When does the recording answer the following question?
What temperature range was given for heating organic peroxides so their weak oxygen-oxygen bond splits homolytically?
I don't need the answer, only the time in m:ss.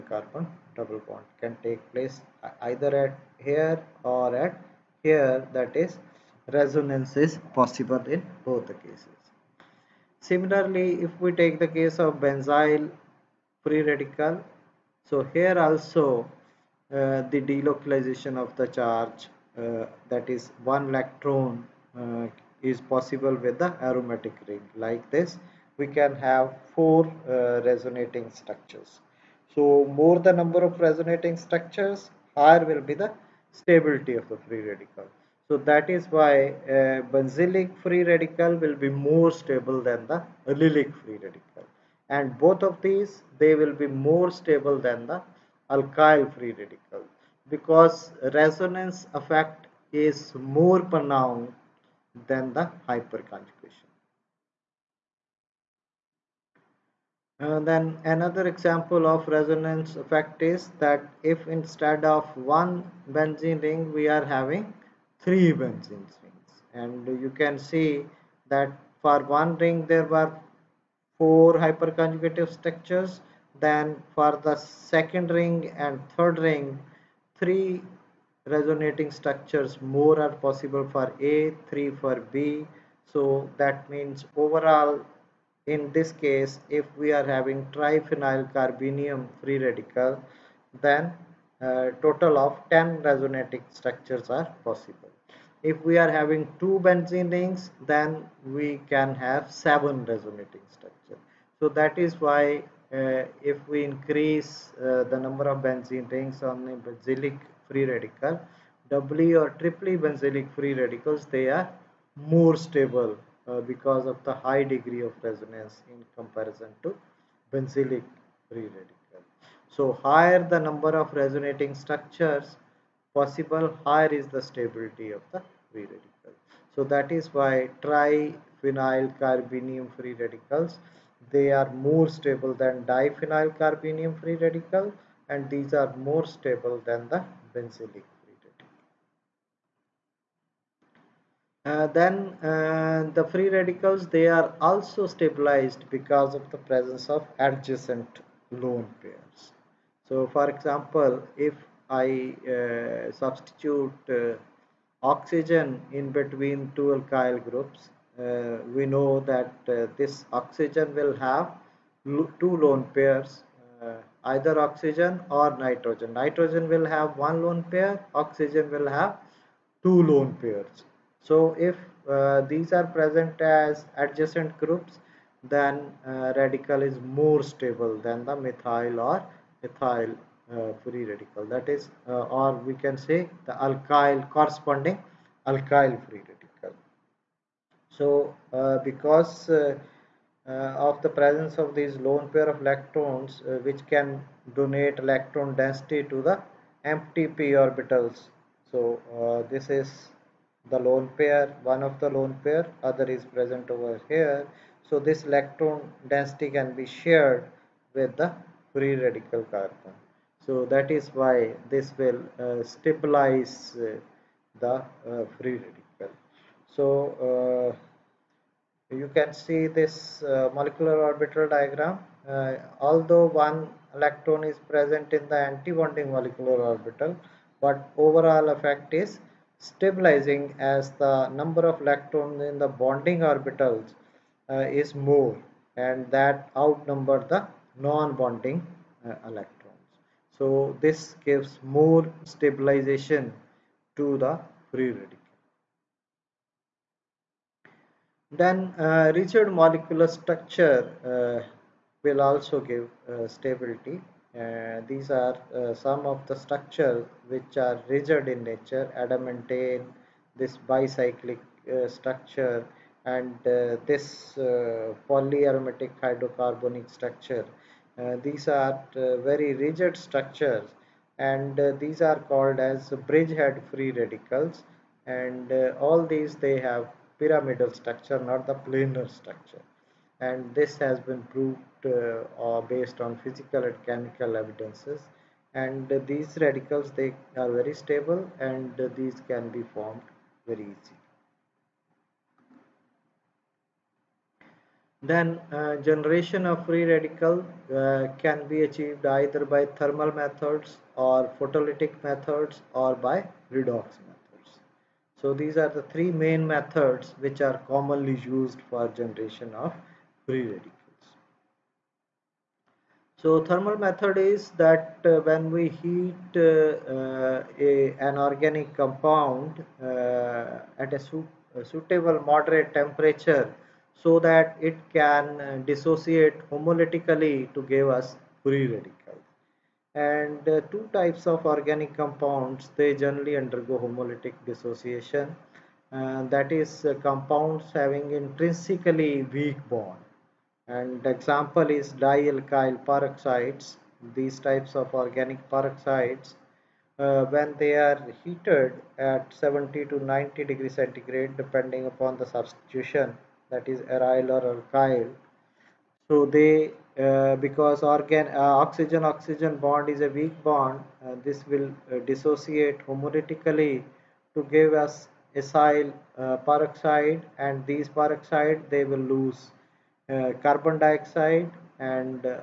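5:49.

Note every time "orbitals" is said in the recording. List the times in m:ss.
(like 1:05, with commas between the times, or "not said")
3:17, 3:41, 3:46, 3:53.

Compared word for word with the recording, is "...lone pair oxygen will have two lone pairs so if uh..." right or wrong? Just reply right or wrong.
right.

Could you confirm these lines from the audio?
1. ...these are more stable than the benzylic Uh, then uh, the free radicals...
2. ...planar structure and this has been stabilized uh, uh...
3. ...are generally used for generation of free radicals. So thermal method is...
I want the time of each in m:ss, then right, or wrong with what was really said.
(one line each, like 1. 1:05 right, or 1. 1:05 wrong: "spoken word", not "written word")
1. 2:15 right
2. 4:38 wrong: "proved", not "stabilized"
3. 5:07 wrong: "commonly", not "generally".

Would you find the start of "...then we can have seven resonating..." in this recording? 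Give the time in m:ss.
1:37.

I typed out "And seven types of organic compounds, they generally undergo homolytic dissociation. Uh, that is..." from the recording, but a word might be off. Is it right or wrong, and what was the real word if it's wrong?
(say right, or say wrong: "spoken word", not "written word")
wrong: "two", not "seven".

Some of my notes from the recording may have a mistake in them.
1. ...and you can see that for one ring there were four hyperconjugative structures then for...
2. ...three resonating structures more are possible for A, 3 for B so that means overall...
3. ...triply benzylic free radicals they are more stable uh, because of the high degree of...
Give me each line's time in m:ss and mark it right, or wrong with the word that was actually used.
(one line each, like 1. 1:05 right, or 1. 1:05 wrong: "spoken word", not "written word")
1. 1:06 right
2. 1:17 right
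3. 1:49 right.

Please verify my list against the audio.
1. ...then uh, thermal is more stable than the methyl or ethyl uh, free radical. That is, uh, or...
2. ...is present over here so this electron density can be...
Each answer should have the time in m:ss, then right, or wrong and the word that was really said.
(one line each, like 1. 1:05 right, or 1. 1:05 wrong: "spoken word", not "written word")
1. 2:55 wrong: "radical", not "thermal"
2. 3:23 right.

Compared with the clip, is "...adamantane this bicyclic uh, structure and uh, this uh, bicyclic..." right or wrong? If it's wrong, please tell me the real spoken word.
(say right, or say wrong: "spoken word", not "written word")
wrong: "polyaromatic", not "bicyclic".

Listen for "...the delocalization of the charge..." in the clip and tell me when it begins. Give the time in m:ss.
0:17.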